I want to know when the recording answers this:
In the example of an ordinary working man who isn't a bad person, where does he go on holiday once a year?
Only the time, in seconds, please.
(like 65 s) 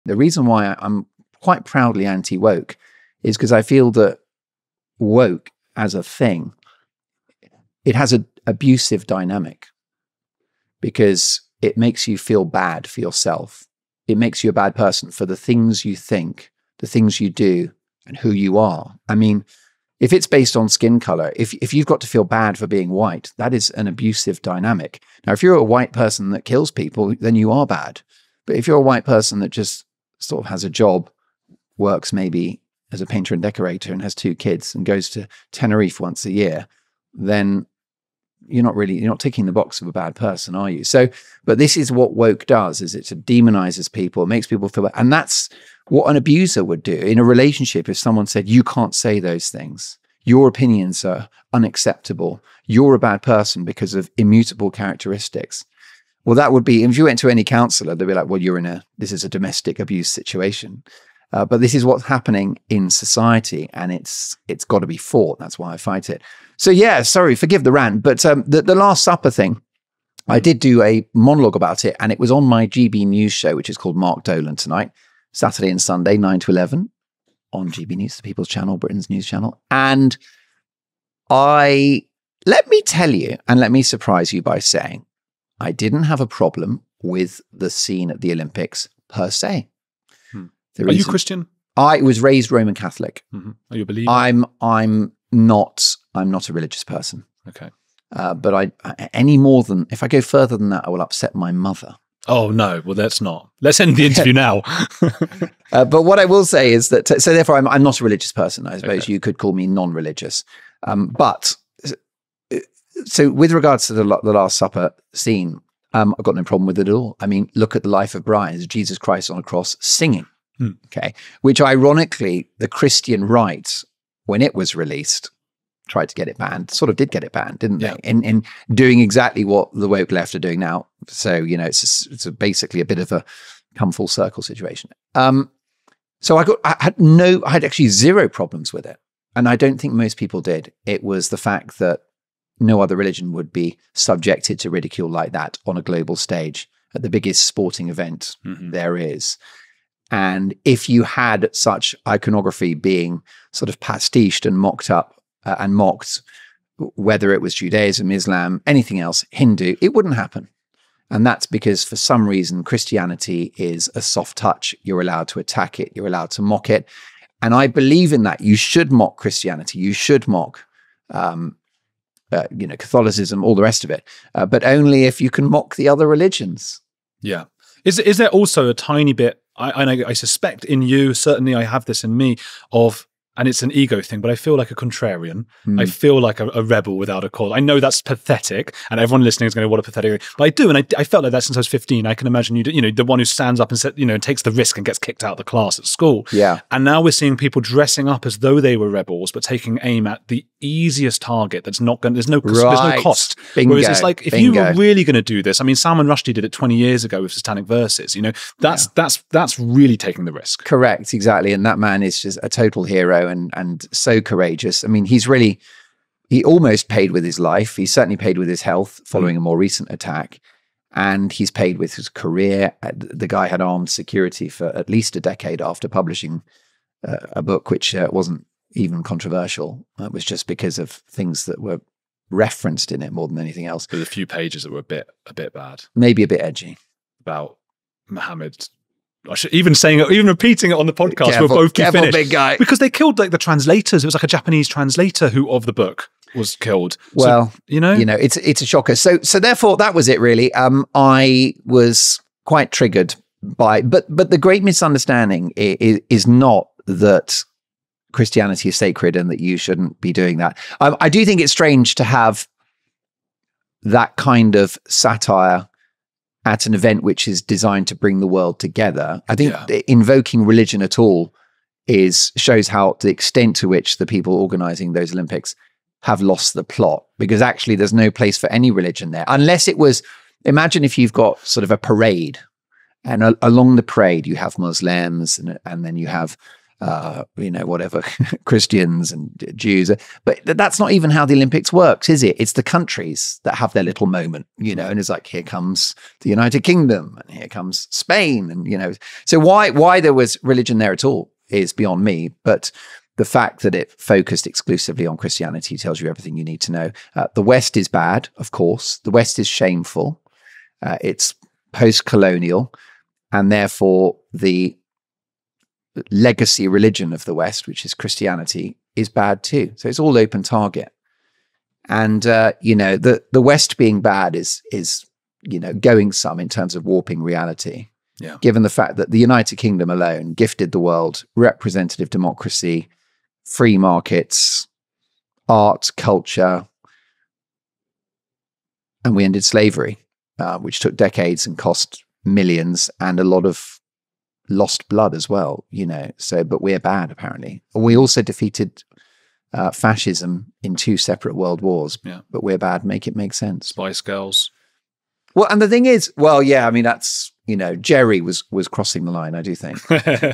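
35 s.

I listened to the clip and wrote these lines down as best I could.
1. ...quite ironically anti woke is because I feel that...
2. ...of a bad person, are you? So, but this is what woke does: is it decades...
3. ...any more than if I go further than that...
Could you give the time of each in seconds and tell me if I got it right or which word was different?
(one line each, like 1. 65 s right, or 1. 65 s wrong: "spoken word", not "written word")
1. 1 s wrong: "proudly", not "ironically"
2. 39 s wrong: "demonizes", not "decades"
3. 99 s right.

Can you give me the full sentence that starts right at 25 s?
Now, if you're a white person that kills people, then you are bad.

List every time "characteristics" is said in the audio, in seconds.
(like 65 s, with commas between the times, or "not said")
54 s.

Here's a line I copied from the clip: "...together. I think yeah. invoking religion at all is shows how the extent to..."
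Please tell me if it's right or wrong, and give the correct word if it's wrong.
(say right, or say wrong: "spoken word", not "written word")
right.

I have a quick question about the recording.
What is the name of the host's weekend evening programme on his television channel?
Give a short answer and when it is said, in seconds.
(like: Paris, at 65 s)
Mark Dolan Tonight, at 73 s.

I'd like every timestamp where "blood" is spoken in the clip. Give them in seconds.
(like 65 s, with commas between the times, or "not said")
344 s.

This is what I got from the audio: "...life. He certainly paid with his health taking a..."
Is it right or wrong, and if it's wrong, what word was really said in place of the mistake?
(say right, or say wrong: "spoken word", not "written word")
wrong: "following", not "taking".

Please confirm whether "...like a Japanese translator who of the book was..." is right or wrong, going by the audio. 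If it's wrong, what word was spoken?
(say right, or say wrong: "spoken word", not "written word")
right.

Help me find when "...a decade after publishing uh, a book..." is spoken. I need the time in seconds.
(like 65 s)
225 s.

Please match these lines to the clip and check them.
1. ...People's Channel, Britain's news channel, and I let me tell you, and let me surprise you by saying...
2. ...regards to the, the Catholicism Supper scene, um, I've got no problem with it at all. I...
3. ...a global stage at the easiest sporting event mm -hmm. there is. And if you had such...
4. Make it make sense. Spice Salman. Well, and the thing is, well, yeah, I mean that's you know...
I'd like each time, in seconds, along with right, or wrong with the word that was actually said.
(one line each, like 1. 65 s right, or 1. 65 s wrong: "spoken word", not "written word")
1. 78 s right
2. 113 s wrong: "Last", not "Catholicism"
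3. 145 s wrong: "biggest", not "easiest"
4. 352 s wrong: "Girls", not "Salman".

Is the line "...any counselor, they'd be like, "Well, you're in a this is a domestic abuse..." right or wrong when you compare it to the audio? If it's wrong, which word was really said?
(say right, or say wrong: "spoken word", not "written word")
right.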